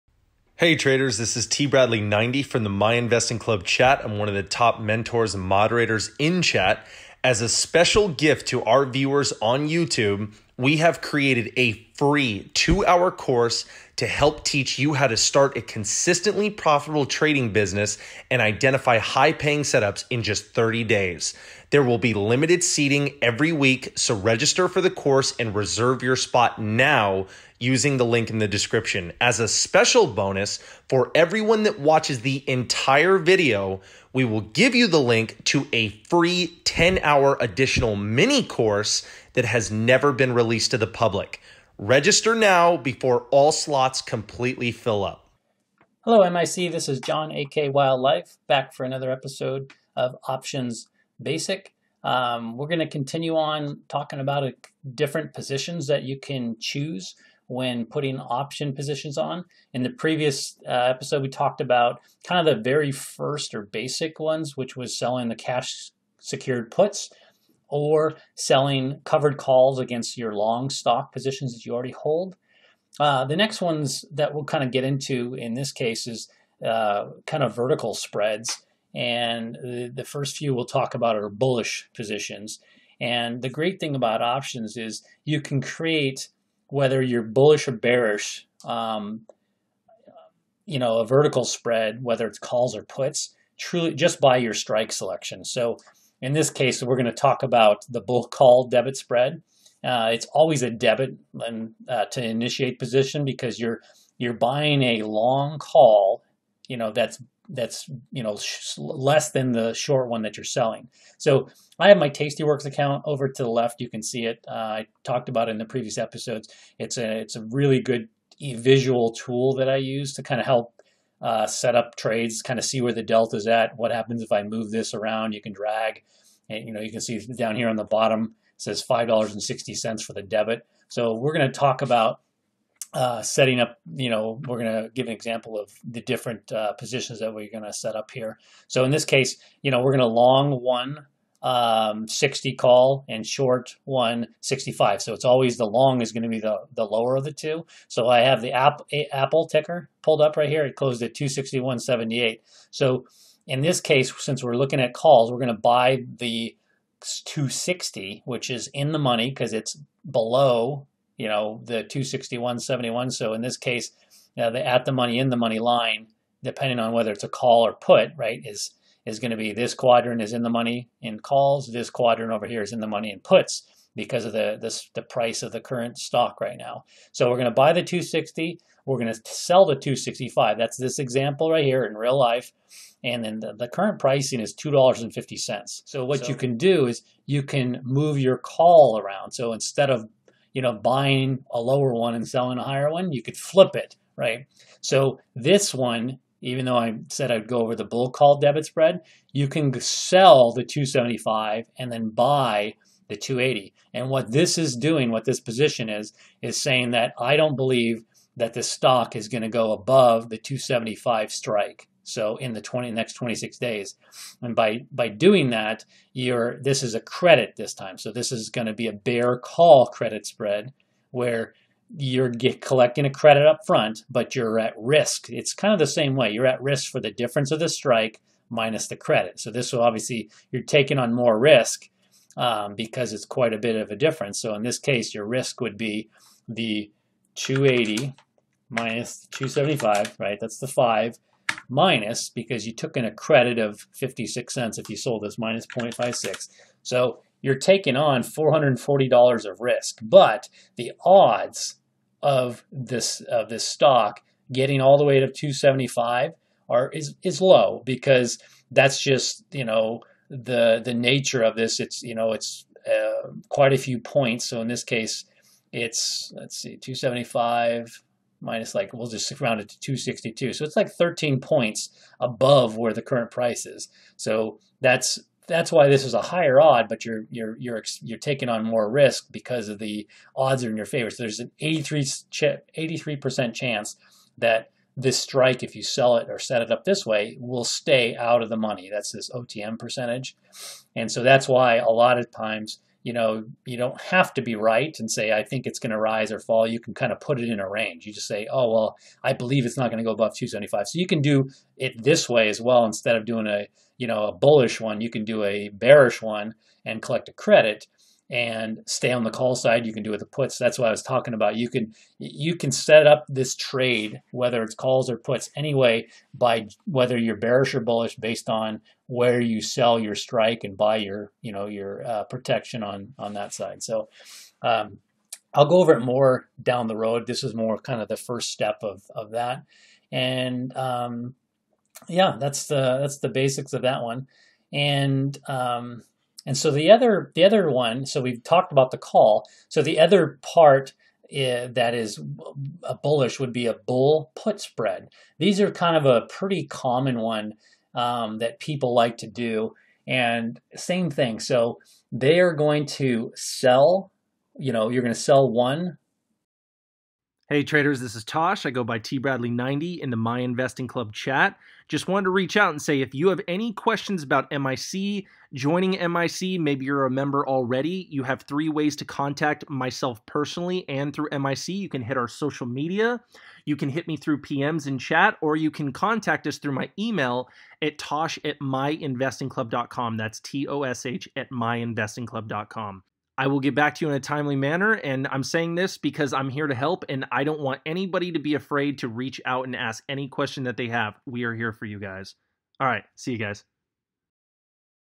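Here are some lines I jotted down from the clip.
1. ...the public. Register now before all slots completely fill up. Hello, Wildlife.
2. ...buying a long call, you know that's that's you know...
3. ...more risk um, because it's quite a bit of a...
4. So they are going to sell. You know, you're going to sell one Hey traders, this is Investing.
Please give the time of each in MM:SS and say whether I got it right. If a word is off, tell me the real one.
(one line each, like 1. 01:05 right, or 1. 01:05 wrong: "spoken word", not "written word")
1. 00:40 wrong: "MIC", not "Wildlife"
2. 01:44 right
3. 03:51 right
4. 05:51 wrong: "Tosh", not "Investing".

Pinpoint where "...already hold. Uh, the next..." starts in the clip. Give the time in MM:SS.
01:11.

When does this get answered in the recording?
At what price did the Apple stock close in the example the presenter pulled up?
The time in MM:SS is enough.
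02:31.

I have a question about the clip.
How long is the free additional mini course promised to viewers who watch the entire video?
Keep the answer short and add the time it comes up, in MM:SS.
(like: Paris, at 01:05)
10 hours, at 00:36.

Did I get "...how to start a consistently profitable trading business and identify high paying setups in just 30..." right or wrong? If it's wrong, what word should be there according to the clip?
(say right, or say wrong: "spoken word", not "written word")
right.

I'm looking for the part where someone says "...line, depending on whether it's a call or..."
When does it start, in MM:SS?
02:45.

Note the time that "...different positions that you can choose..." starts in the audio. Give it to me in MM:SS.
00:54.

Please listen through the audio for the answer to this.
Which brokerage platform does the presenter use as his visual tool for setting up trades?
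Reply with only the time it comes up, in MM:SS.
01:52.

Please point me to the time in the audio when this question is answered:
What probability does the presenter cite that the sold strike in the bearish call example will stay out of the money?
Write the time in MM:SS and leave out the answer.
04:42.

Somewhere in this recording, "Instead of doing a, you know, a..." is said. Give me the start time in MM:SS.
05:02.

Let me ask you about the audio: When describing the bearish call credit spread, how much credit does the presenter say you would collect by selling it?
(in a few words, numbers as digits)
56 cents.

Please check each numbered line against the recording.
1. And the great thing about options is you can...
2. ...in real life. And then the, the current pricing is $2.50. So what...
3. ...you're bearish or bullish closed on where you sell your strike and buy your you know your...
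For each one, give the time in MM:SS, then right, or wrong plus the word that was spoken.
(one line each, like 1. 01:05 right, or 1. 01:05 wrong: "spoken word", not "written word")
1. 01:22 right
2. 03:01 right
3. 05:17 wrong: "based", not "closed".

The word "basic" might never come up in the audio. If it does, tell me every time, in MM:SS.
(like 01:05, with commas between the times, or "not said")
00:51, 01:03, 05:33.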